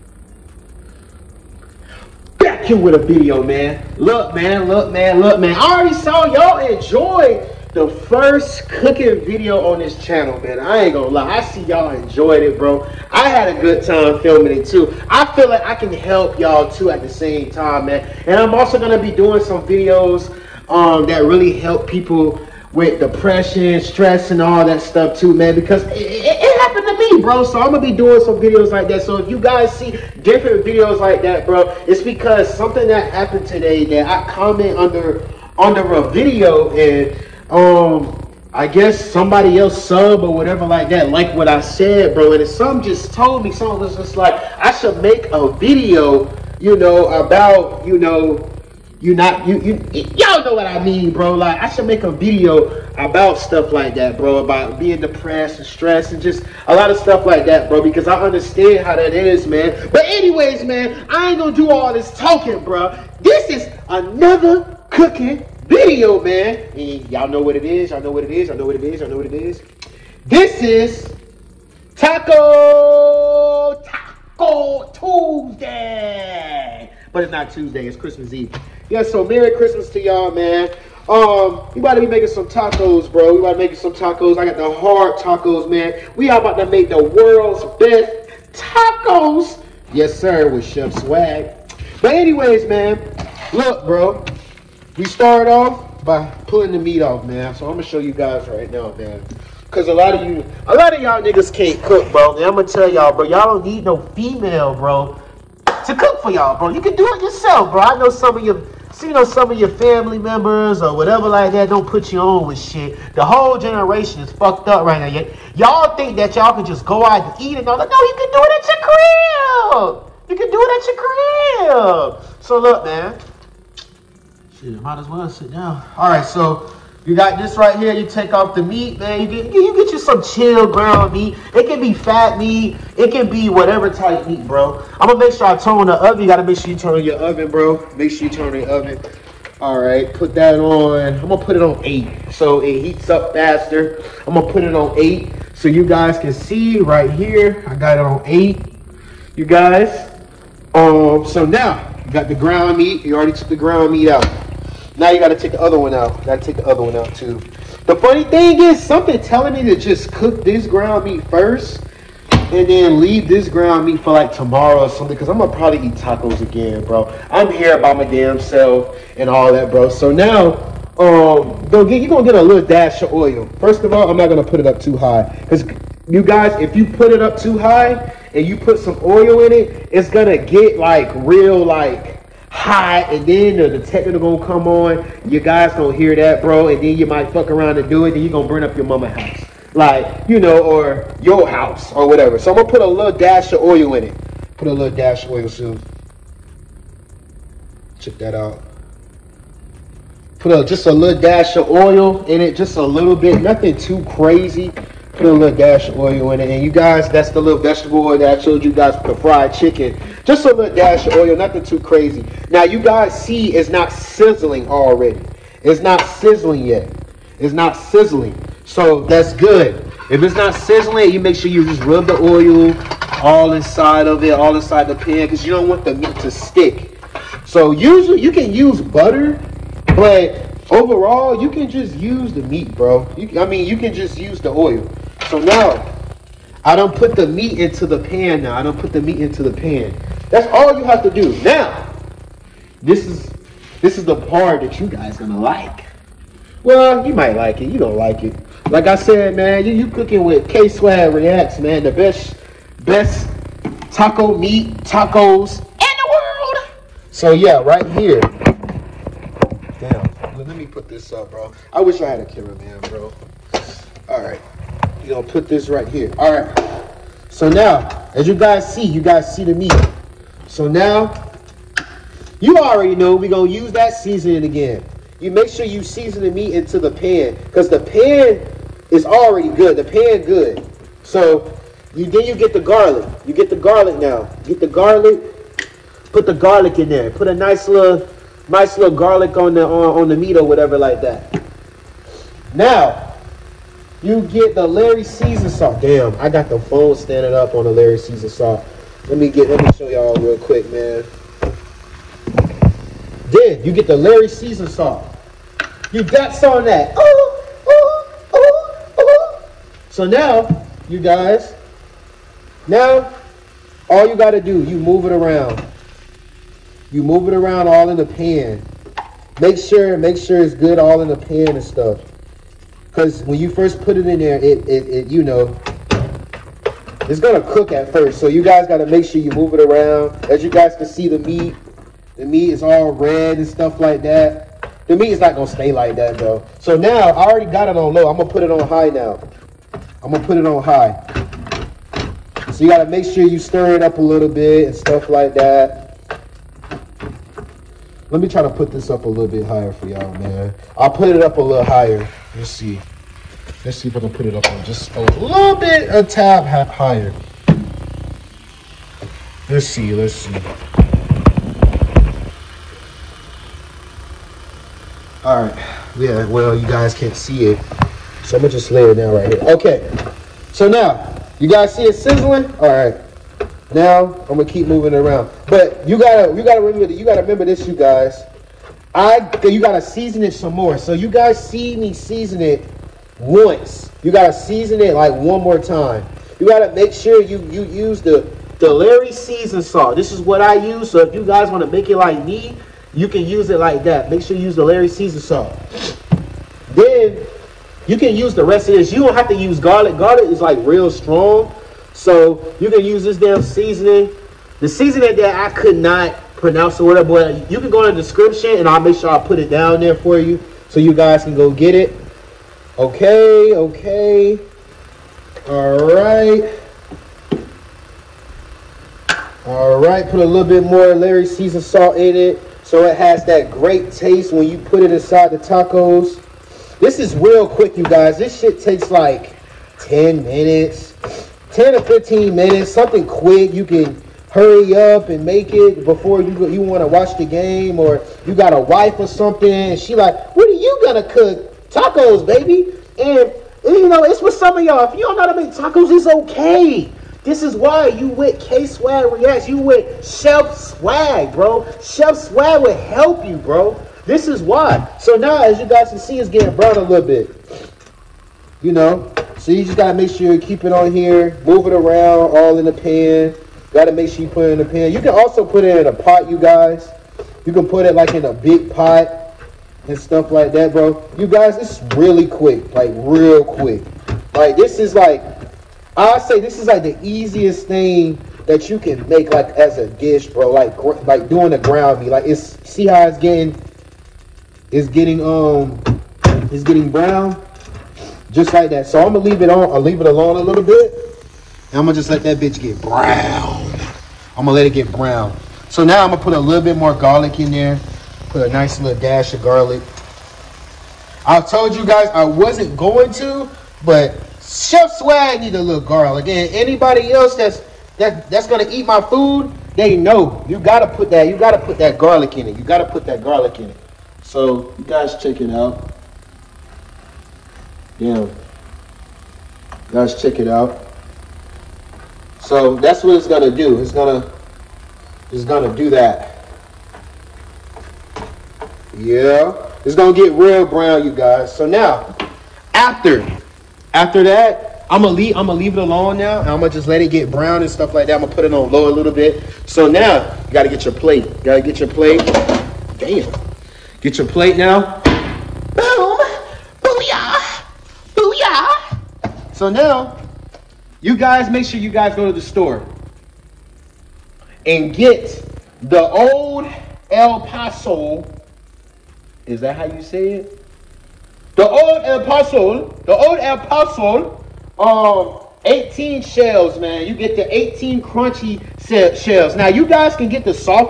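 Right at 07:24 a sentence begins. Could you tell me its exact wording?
If you don't know how to make tacos, it's okay.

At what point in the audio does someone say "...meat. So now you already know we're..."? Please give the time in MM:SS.
04:29.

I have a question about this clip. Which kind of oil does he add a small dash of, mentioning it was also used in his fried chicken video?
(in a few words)
vegetable oil.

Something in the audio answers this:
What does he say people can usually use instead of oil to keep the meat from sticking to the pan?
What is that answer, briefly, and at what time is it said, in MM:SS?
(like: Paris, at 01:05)
butter, at 03:48.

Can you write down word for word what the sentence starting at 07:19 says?
she like, what are you gonna cook?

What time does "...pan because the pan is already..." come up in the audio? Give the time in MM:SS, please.
04:36.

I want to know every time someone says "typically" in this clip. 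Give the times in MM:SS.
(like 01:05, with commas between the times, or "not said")
not said.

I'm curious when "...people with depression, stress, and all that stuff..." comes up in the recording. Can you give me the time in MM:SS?
00:21.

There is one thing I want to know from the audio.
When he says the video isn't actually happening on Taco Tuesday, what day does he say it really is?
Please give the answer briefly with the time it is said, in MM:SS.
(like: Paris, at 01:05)
Christmas Eve, at 01:17.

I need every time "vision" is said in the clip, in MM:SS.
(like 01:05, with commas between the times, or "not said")
not said.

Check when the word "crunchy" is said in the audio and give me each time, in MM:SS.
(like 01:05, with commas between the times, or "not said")
09:28.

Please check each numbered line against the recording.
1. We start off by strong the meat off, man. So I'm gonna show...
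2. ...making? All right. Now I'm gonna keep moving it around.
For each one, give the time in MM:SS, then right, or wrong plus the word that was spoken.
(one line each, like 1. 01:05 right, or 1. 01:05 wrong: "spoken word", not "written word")
1. 01:34 wrong: "pulling", not "strong"
2. 06:11 wrong: "sizzling", not "making".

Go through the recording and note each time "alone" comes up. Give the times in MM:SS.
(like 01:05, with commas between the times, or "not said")
08:10, 08:55.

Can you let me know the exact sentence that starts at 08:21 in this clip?
I told you guys I wasn't going to, but Chef Swag need a little garlic.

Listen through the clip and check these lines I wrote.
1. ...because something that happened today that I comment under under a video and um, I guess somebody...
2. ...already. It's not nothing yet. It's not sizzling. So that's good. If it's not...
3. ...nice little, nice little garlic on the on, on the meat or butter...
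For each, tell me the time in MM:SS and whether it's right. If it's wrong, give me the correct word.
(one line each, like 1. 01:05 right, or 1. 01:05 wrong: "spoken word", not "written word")
1. 00:32 right
2. 03:34 wrong: "sizzling", not "nothing"
3. 04:47 wrong: "whatever", not "butter".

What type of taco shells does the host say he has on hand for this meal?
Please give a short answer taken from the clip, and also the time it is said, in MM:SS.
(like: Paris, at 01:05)
hard tacos, at 01:24.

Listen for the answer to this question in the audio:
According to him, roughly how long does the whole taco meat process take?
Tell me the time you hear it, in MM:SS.
07:11.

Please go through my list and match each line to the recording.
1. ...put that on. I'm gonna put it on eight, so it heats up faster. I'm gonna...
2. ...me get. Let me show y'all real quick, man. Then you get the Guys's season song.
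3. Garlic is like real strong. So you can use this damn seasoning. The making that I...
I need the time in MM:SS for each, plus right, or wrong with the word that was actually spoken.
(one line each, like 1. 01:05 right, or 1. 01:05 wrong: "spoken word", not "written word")
1. 02:20 right
2. 04:59 wrong: "Lawry", not "Guys"
3. 06:39 wrong: "seasoning", not "making".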